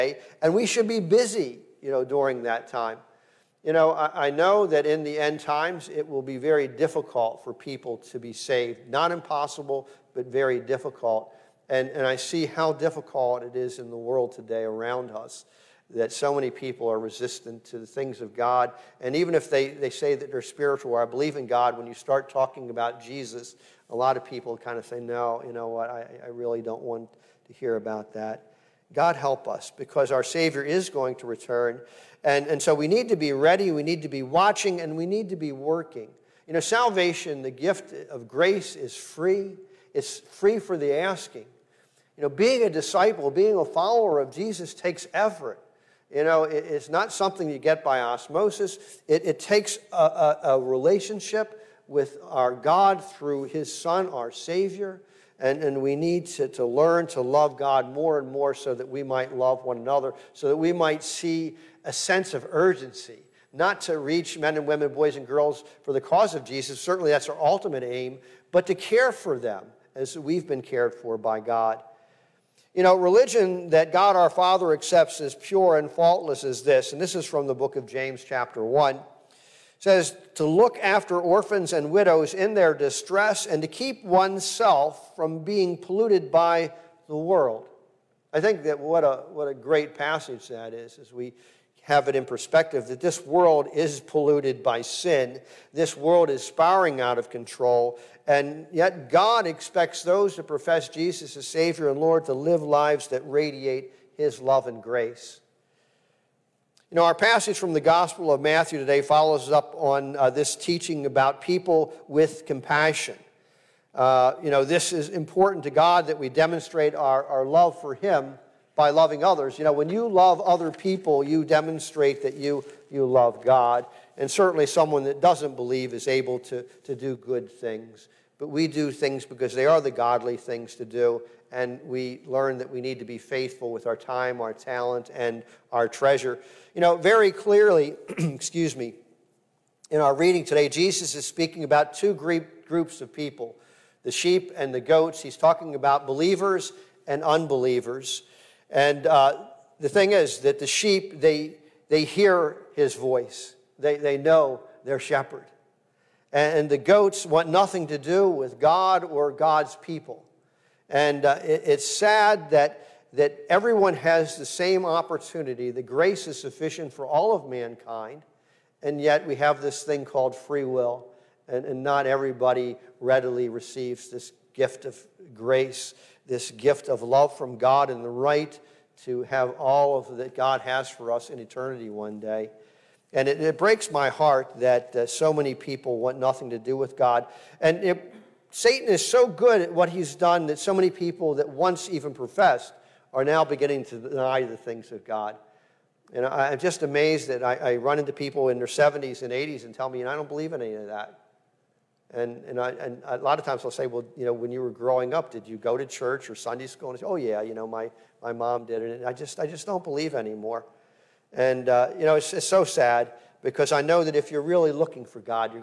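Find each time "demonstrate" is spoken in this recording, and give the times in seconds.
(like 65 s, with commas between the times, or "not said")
116 s, 121 s.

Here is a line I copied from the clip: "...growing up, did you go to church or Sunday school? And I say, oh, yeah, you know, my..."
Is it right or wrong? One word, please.
right.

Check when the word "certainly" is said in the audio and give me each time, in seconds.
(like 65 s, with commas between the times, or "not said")
66 s, 124 s.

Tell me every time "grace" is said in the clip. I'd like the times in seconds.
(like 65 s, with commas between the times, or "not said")
38 s, 104 s, 165 s, 175 s.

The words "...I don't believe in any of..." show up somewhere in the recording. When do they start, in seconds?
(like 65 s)
200 s.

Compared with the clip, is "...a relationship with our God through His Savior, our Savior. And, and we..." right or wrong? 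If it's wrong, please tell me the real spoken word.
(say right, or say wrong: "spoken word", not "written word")
wrong: "Son", not "Savior".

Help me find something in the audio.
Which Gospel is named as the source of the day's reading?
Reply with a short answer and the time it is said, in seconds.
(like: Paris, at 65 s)
Matthew, at 108 s.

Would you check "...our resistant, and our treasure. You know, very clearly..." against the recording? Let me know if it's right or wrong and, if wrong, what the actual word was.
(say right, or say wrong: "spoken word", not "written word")
wrong: "talent", not "resistant".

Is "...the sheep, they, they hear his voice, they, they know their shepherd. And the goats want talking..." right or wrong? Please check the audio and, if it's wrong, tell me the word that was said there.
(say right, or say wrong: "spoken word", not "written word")
wrong: "nothing", not "talking".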